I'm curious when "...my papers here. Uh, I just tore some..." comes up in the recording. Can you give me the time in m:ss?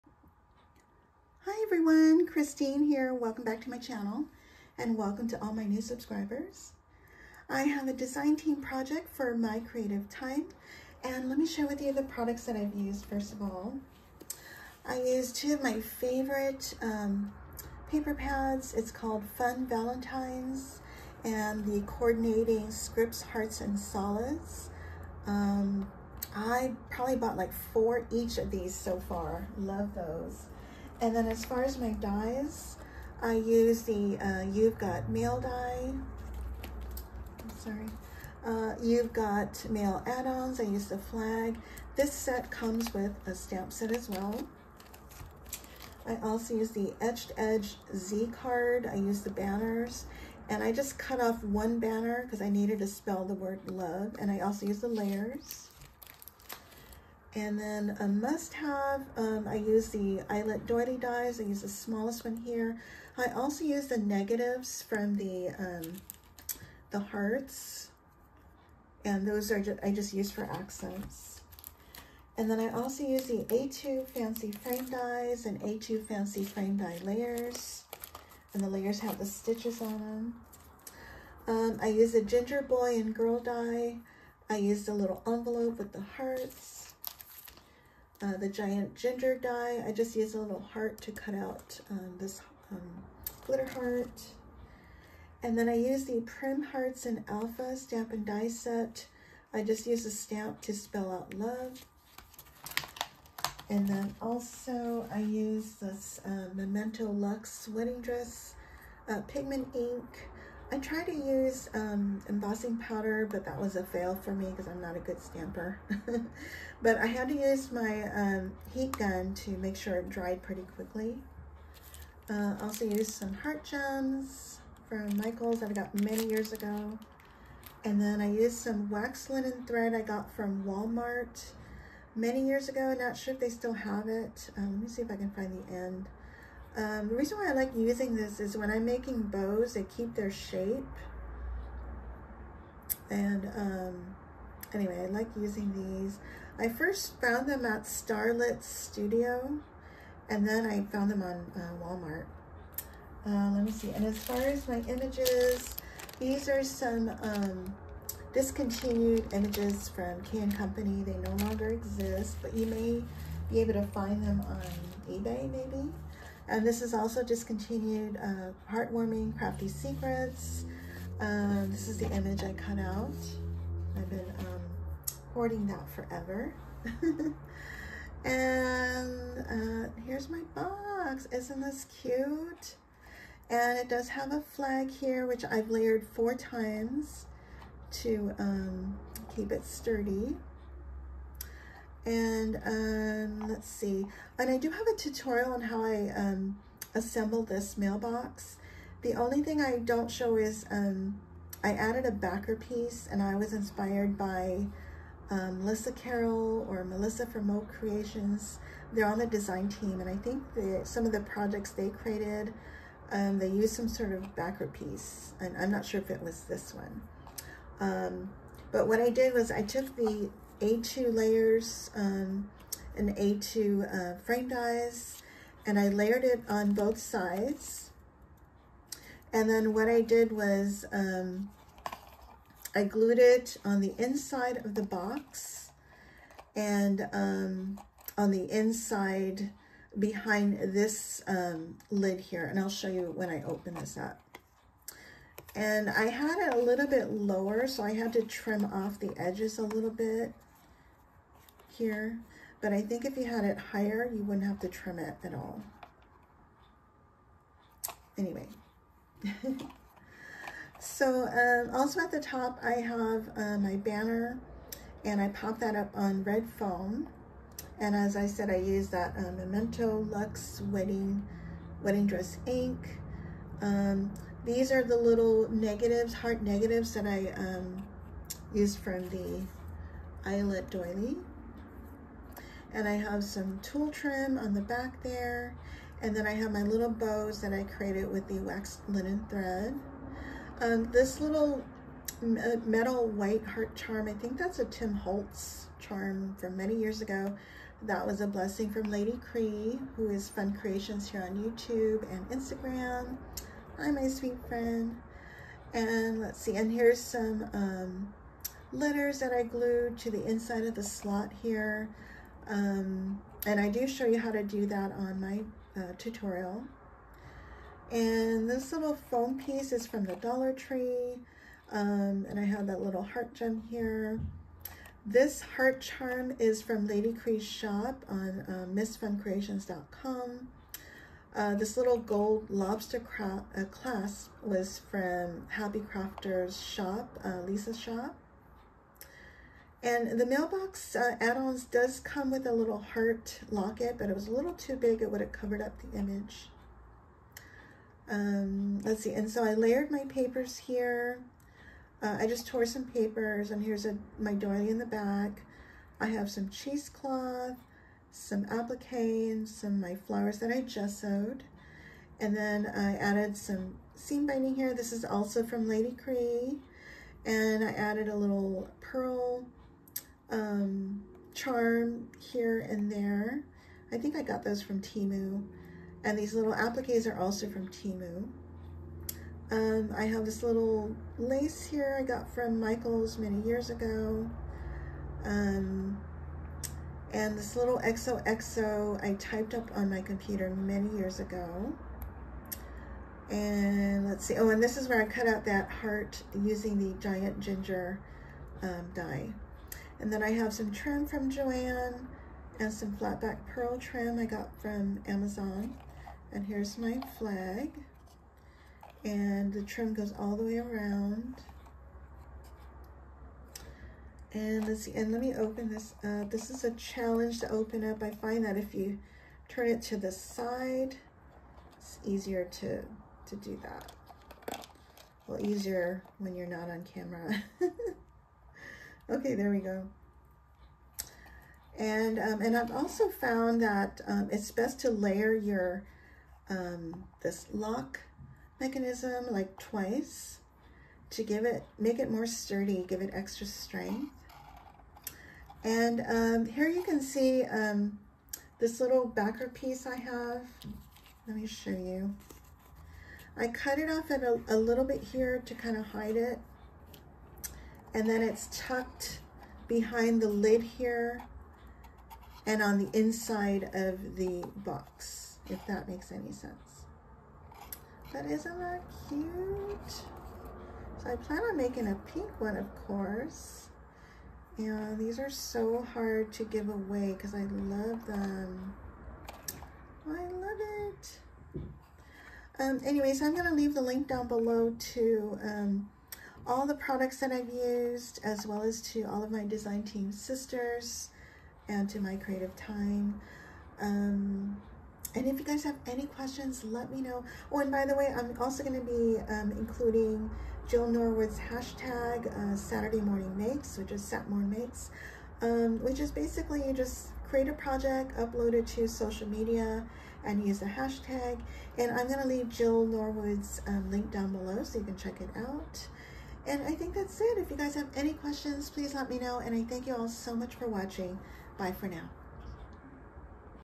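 5:49.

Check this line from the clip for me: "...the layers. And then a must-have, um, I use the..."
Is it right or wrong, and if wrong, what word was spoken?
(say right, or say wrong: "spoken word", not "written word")
right.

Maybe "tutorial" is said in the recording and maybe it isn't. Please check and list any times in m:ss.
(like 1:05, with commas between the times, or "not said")
3:14, 5:15.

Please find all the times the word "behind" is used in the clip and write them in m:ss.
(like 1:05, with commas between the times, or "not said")
3:59, 7:39.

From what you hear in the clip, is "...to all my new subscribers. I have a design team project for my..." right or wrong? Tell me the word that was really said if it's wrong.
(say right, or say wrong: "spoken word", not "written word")
right.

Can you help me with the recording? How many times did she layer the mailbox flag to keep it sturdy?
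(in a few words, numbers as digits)
4.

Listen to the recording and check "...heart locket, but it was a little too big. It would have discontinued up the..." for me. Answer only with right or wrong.
wrong.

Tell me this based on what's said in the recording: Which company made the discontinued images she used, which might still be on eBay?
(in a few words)
Can Company.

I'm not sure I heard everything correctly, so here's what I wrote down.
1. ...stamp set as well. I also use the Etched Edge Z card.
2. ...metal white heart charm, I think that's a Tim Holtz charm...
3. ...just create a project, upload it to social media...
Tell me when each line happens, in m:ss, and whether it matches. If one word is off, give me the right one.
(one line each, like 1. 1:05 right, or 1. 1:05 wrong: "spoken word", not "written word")
1. 0:43 right
2. 4:52 right
3. 8:26 right.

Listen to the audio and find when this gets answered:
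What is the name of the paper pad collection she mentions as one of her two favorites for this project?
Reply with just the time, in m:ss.
0:19.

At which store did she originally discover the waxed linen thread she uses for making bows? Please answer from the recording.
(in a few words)
Starlit Studio.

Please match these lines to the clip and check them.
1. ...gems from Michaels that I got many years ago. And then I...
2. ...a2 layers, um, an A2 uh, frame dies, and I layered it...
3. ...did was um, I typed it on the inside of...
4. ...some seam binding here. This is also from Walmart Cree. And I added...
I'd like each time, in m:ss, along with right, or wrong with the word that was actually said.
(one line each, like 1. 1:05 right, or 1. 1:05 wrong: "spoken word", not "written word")
1. 2:03 right
2. 3:40 right
3. 3:50 wrong: "glued", not "typed"
4. 6:03 wrong: "Lady", not "Walmart".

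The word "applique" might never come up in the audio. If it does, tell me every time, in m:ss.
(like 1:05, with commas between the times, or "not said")
5:58, 6:16.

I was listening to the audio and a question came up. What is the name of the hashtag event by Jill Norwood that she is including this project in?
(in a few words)
Saturday Morning Makes.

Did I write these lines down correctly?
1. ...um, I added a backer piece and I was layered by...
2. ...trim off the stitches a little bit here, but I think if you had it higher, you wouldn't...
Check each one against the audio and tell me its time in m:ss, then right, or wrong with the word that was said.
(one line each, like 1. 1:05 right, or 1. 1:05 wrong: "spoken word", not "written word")
1. 3:20 wrong: "inspired", not "layered"
2. 4:08 wrong: "edges", not "stitches".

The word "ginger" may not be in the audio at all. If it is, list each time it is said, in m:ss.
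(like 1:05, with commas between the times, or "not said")
1:22, 1:28, 6:37.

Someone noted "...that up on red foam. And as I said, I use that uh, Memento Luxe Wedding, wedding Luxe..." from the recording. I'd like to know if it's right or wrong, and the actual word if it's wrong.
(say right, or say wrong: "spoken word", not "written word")
wrong: "Dress", not "Luxe".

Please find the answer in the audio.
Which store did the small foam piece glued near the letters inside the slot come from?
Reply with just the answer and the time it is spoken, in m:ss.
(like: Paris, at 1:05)
Dollar Tree, at 5:20.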